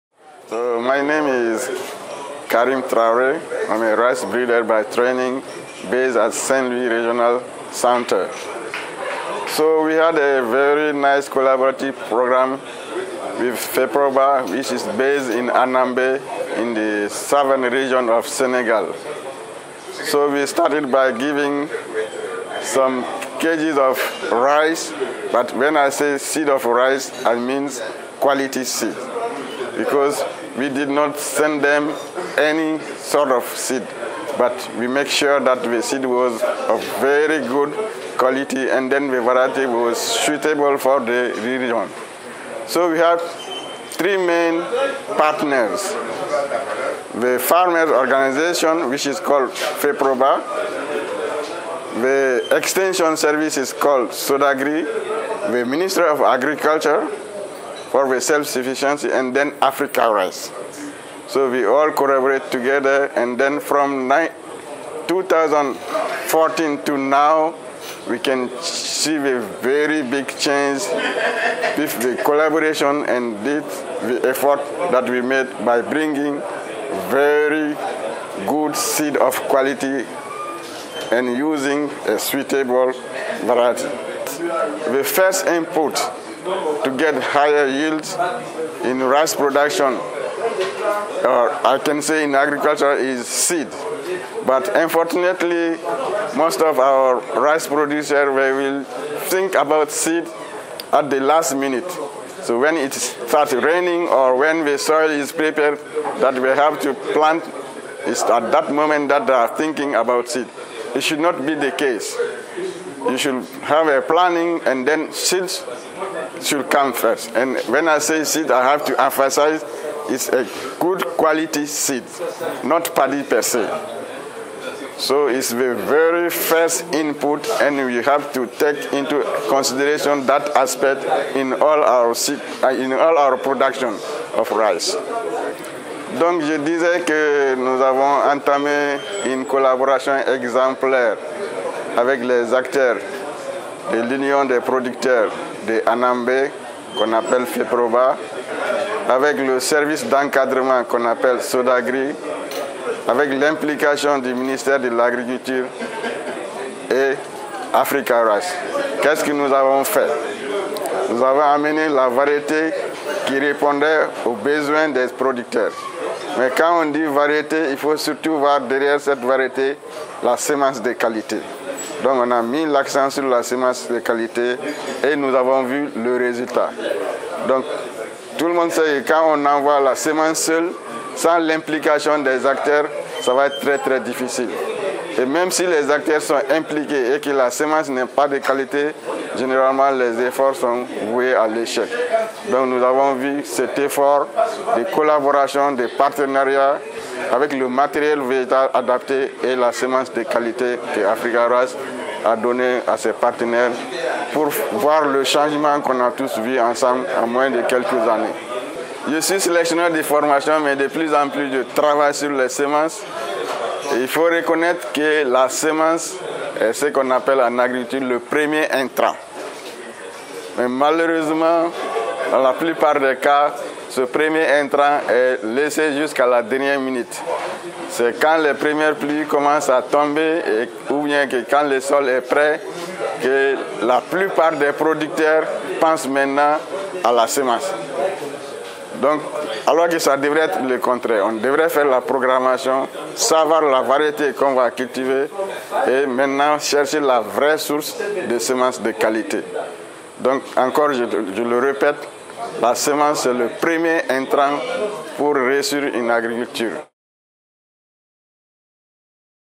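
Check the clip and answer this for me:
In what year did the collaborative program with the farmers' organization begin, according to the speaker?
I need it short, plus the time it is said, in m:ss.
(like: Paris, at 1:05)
2014, at 1:05.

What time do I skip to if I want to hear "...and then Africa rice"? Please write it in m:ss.
0:59.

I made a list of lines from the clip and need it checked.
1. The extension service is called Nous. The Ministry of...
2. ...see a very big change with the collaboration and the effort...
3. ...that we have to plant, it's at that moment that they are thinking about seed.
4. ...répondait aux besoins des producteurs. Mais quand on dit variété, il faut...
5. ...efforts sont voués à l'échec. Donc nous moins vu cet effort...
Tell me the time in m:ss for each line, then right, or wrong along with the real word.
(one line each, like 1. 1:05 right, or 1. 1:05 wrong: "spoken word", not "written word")
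1. 0:52 wrong: "SODAGRI", not "Nous"
2. 1:08 right
3. 1:46 right
4. 2:43 right
5. 3:10 wrong: "avons", not "moins".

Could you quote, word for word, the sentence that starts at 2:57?
Donc tout le monde sait que quand on envoie la semence seule, sans l'implication des acteurs, ça va être très très difficile.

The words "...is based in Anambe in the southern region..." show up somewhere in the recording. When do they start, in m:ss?
0:14.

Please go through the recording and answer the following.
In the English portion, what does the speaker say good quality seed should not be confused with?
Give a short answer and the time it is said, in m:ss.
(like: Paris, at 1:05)
paddy, at 2:02.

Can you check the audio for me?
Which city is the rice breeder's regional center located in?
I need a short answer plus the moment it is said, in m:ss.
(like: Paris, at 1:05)
St. Louis, at 0:06.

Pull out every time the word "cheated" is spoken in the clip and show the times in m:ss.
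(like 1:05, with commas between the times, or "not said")
not said.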